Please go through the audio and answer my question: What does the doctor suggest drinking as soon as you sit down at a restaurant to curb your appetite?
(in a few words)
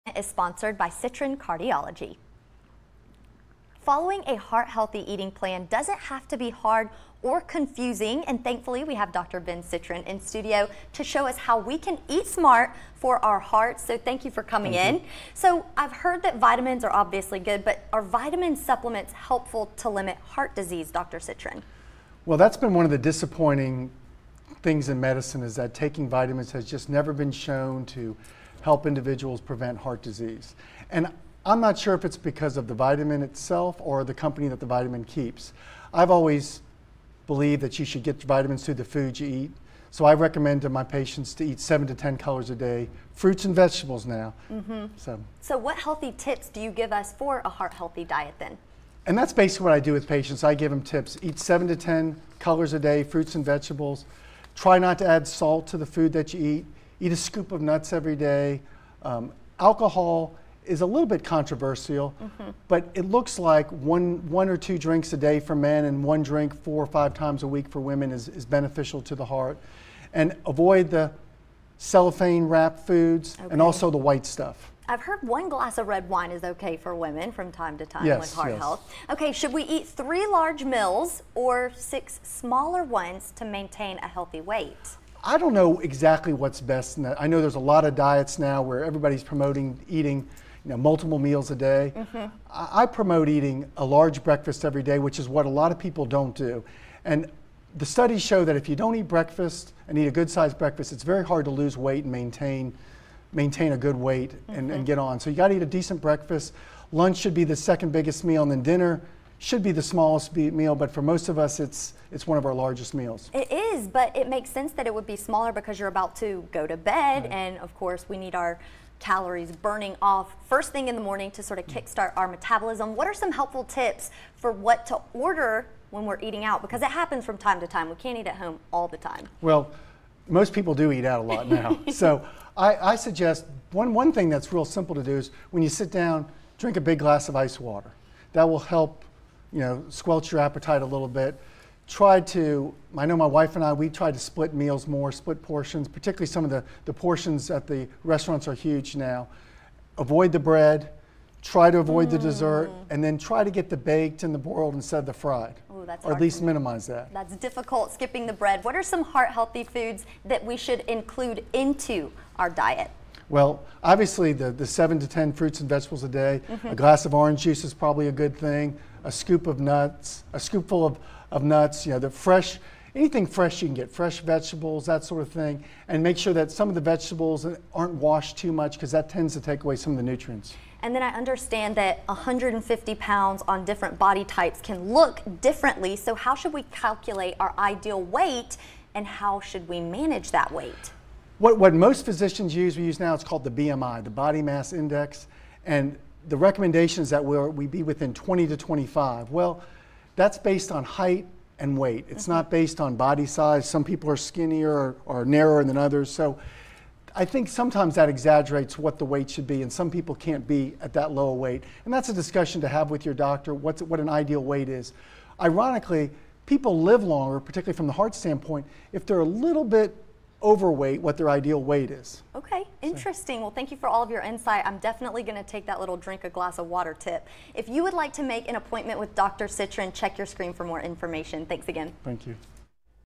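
a big glass of ice water.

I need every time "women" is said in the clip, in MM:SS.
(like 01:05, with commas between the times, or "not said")
01:07, 01:17.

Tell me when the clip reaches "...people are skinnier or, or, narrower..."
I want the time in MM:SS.
03:23.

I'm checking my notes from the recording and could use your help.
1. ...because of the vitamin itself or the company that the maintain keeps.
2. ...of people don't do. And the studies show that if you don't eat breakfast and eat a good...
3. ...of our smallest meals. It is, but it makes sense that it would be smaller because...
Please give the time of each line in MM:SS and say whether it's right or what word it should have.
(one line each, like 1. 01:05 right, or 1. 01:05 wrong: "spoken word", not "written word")
1. 00:32 wrong: "vitamin", not "maintain"
2. 01:35 right
3. 01:52 wrong: "largest", not "smallest".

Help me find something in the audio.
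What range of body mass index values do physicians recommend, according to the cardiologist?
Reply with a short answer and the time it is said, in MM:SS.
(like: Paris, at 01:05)
20 to 25, at 03:18.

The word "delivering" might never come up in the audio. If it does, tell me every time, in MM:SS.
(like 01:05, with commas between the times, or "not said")
not said.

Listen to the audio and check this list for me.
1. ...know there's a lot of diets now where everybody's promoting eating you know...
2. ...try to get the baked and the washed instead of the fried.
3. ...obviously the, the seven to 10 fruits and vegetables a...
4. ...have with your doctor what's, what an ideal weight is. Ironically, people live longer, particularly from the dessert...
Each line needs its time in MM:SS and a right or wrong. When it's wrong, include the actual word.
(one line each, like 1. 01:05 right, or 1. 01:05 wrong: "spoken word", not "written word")
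1. 01:27 right
2. 02:33 wrong: "boiled", not "washed"
3. 02:43 right
4. 03:32 wrong: "heart", not "dessert".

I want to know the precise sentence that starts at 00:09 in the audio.
Ben Citrin in studio to show us how we can eat smart for our hearts, so thank you for coming thank in.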